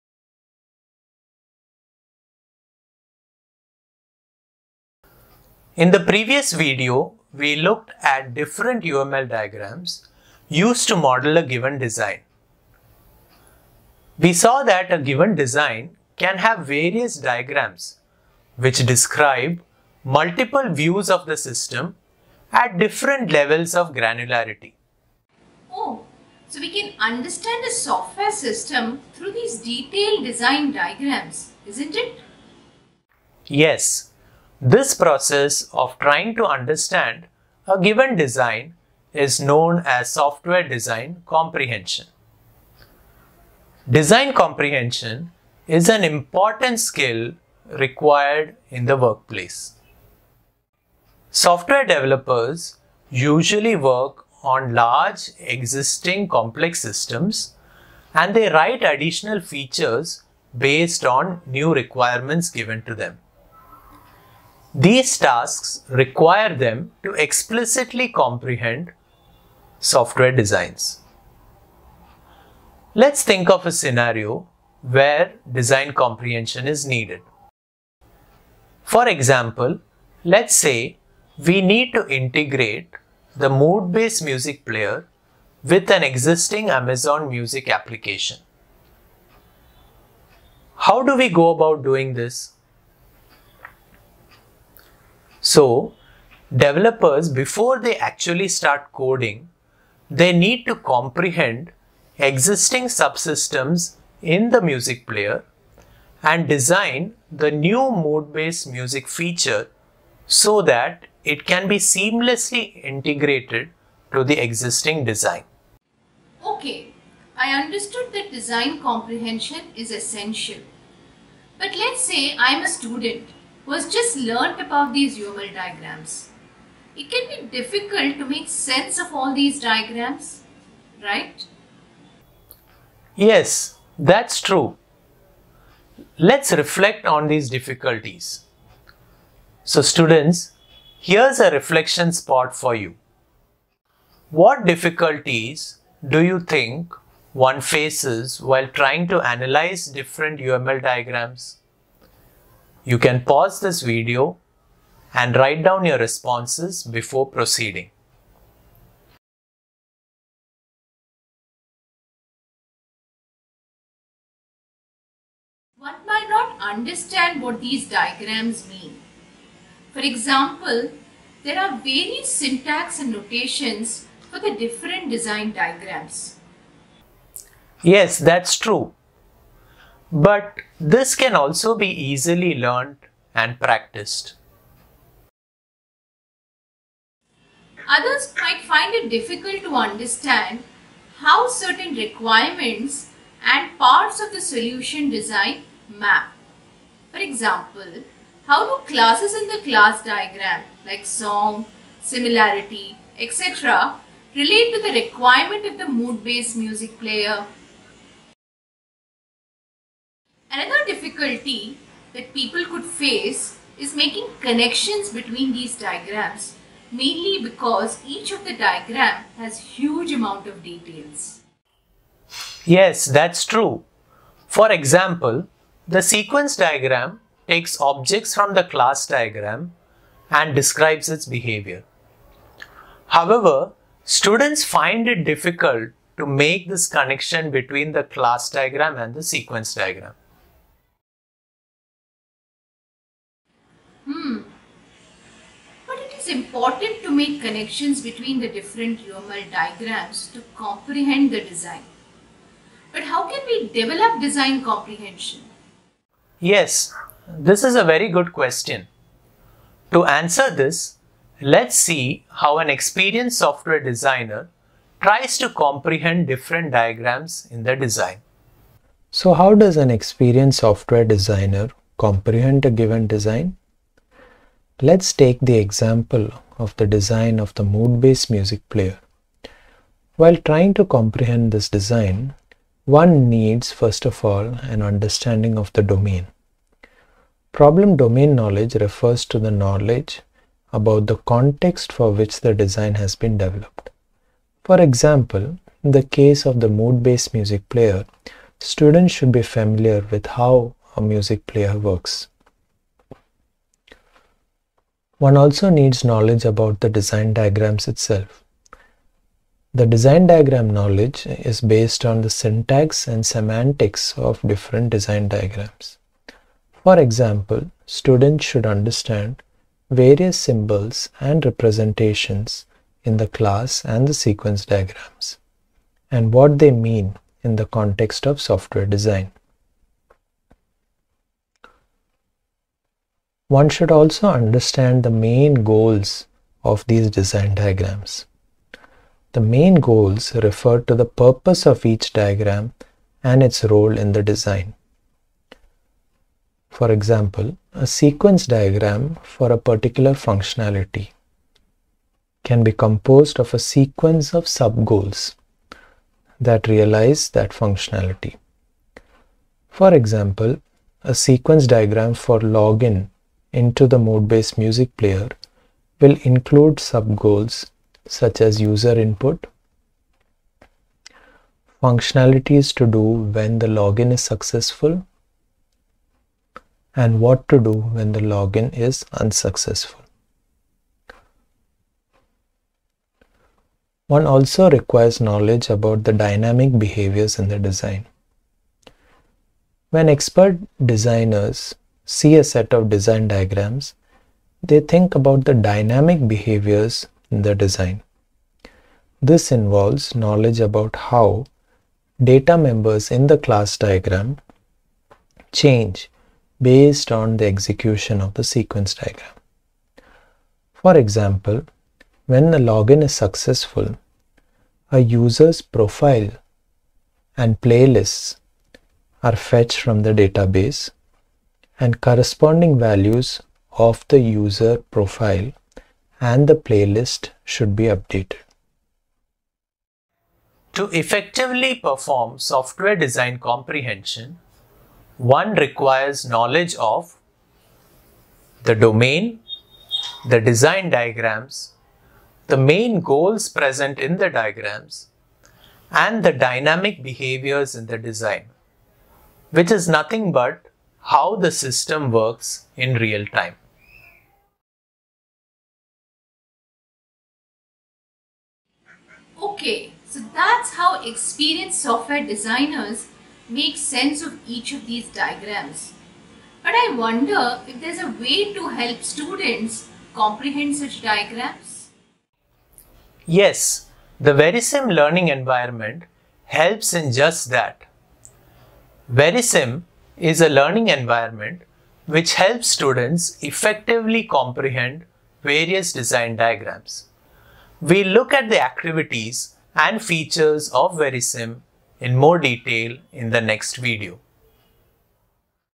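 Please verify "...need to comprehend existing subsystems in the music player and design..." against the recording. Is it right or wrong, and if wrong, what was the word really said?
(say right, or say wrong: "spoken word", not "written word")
right.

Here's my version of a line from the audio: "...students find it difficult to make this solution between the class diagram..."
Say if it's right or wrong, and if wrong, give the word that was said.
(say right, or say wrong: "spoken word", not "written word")
wrong: "connection", not "solution".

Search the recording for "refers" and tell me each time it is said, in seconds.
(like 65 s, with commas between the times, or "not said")
288 s, 340 s.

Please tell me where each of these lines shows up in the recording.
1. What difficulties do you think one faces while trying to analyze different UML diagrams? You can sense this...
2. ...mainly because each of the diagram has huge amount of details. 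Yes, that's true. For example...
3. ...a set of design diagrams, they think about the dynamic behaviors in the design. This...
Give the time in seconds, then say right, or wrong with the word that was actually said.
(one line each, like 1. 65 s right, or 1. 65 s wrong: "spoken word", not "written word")
1. 144 s wrong: "pause", not "sense"
2. 216 s right
3. 392 s right.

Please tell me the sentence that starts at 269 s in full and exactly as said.
So how does an experienced software designer comprehend a given design?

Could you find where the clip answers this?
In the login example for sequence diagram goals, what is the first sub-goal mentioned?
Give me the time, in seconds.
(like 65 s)
368 s.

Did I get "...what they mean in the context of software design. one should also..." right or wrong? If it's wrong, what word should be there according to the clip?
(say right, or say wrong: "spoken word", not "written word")
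right.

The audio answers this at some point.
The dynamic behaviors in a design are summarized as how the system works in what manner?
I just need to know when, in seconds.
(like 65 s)
452 s.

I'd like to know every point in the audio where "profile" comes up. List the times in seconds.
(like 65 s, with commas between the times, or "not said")
415 s, 424 s.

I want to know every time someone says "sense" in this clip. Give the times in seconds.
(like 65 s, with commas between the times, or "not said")
128 s, 463 s.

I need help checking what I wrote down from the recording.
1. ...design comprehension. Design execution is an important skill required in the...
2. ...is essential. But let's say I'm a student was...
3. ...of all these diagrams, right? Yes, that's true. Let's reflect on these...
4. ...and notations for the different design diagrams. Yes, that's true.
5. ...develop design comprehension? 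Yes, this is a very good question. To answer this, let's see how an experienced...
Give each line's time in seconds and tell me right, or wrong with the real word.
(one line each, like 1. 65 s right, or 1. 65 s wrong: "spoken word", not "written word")
1. 40 s wrong: "comprehension", not "execution"
2. 119 s right
3. 128 s right
4. 172 s right
5. 253 s right.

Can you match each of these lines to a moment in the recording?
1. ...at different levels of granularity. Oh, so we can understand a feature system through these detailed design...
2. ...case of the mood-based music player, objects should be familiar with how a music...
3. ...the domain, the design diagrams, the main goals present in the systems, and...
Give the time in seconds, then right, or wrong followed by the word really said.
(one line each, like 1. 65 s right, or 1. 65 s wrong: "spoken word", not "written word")
1. 22 s wrong: "software", not "feature"
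2. 296 s wrong: "students", not "objects"
3. 438 s wrong: "diagrams", not "systems".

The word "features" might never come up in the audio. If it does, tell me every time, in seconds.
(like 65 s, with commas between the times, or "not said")
59 s, 109 s, 489 s.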